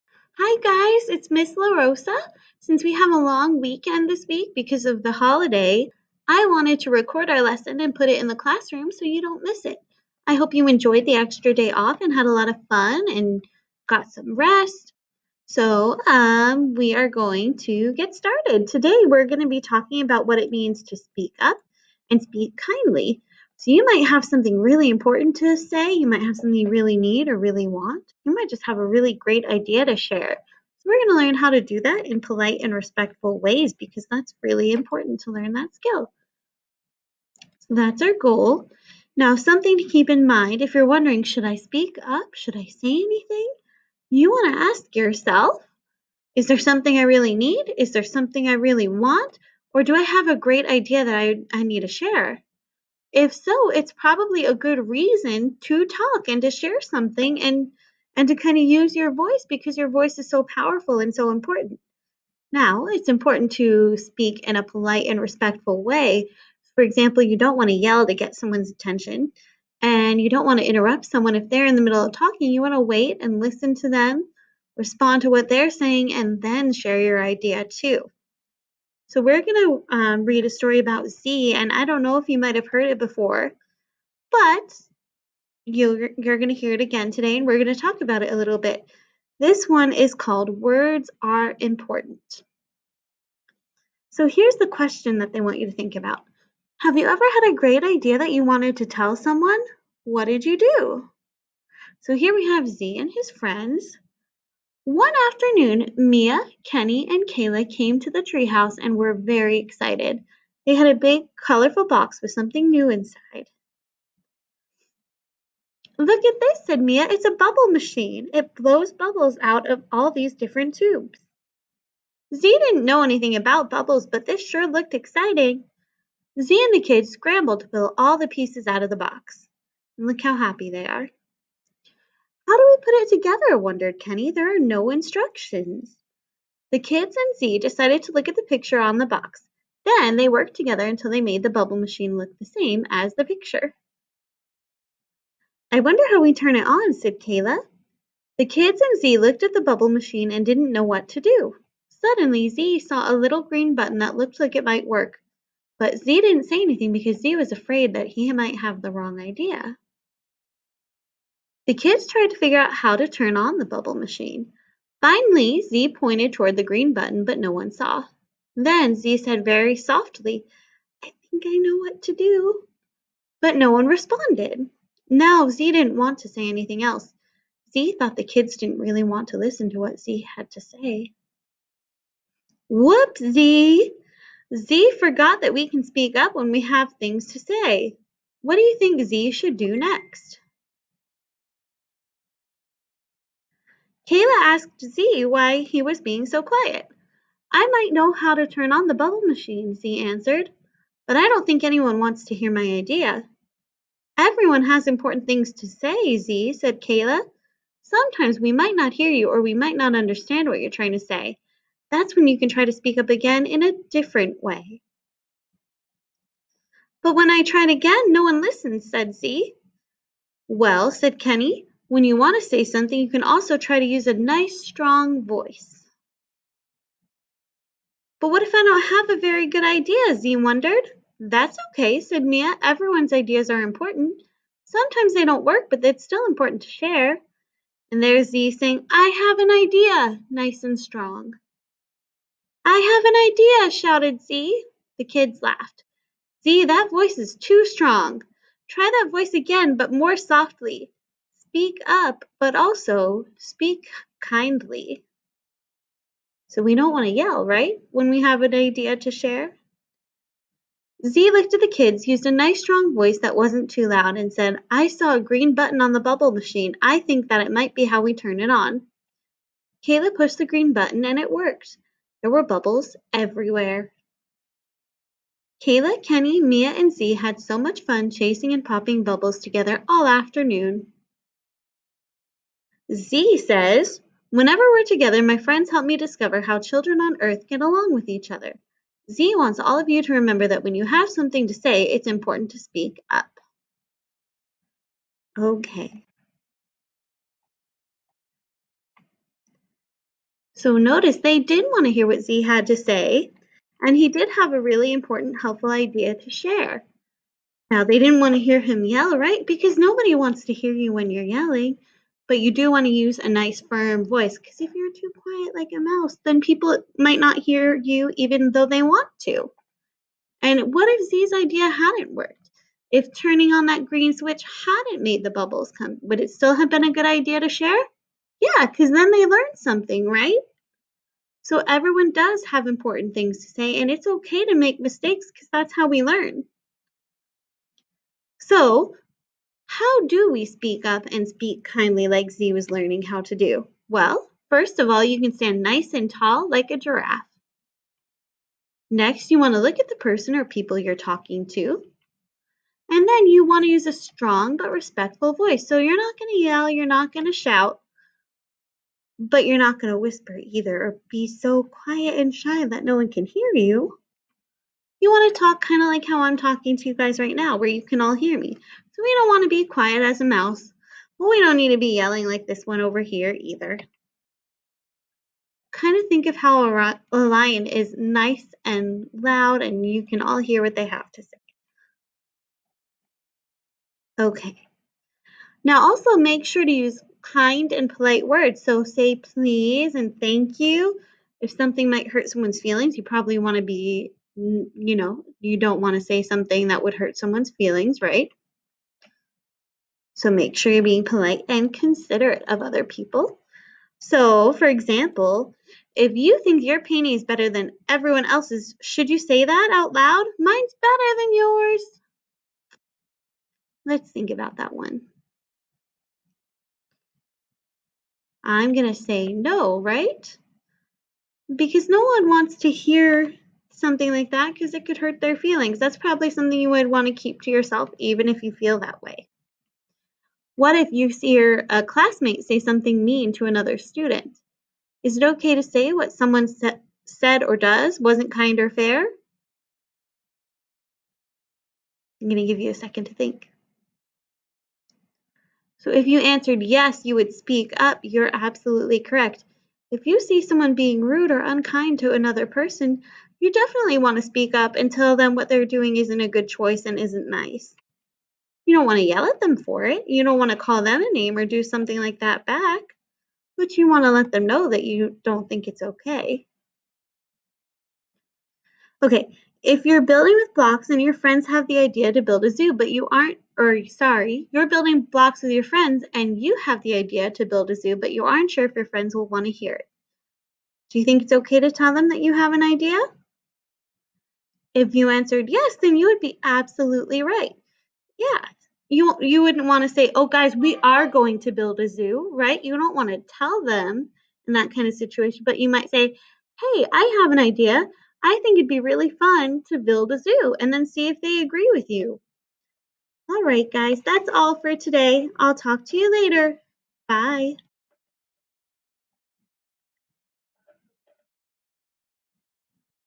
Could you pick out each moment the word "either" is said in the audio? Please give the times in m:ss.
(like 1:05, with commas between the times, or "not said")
6:00, 6:13.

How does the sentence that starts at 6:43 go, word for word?
So, for example, if you think your painting is better than everyone else's, should you say that out loud?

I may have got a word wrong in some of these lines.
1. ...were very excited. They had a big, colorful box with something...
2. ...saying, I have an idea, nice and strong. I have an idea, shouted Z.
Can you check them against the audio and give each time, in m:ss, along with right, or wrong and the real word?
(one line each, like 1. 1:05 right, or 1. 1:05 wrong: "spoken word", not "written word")
1. 1:48 right
2. 3:58 right.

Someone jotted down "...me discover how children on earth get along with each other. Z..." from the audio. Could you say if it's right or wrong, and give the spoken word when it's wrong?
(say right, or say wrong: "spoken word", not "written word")
right.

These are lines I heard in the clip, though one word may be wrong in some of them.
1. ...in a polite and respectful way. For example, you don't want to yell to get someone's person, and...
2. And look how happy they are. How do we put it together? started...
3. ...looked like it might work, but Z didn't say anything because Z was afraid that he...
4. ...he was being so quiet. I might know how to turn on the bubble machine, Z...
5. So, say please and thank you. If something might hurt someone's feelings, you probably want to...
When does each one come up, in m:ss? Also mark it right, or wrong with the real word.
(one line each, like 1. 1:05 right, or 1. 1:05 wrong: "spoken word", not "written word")
1. 1:04 wrong: "attention", not "person"
2. 2:09 wrong: "wondered", not "started"
3. 2:34 right
4. 3:15 right
5. 6:28 right.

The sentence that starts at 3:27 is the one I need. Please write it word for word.
Sometimes we might not hear you or we might not understand what you're trying to say.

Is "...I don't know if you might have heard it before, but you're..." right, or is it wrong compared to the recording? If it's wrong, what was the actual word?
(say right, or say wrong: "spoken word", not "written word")
right.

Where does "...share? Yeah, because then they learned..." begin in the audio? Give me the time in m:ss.
5:27.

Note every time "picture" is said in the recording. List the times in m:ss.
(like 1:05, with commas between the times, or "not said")
2:18, 2:23.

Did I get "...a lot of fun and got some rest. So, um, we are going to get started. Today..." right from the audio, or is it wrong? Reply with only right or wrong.
right.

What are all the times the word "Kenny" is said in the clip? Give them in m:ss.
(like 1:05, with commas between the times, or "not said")
1:46, 2:13, 3:41, 4:36.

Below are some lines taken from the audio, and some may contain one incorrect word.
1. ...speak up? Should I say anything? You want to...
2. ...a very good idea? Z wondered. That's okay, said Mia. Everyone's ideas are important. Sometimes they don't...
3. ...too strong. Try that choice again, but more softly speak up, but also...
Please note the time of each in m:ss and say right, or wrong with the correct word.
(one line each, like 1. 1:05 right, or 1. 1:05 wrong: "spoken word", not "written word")
1. 0:41 right
2. 3:49 right
3. 4:07 wrong: "voice", not "choice".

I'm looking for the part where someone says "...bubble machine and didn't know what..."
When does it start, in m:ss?
2:29.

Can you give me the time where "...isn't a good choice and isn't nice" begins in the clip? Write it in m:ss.
7:35.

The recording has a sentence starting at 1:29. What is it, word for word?
This one is called Words Are Important.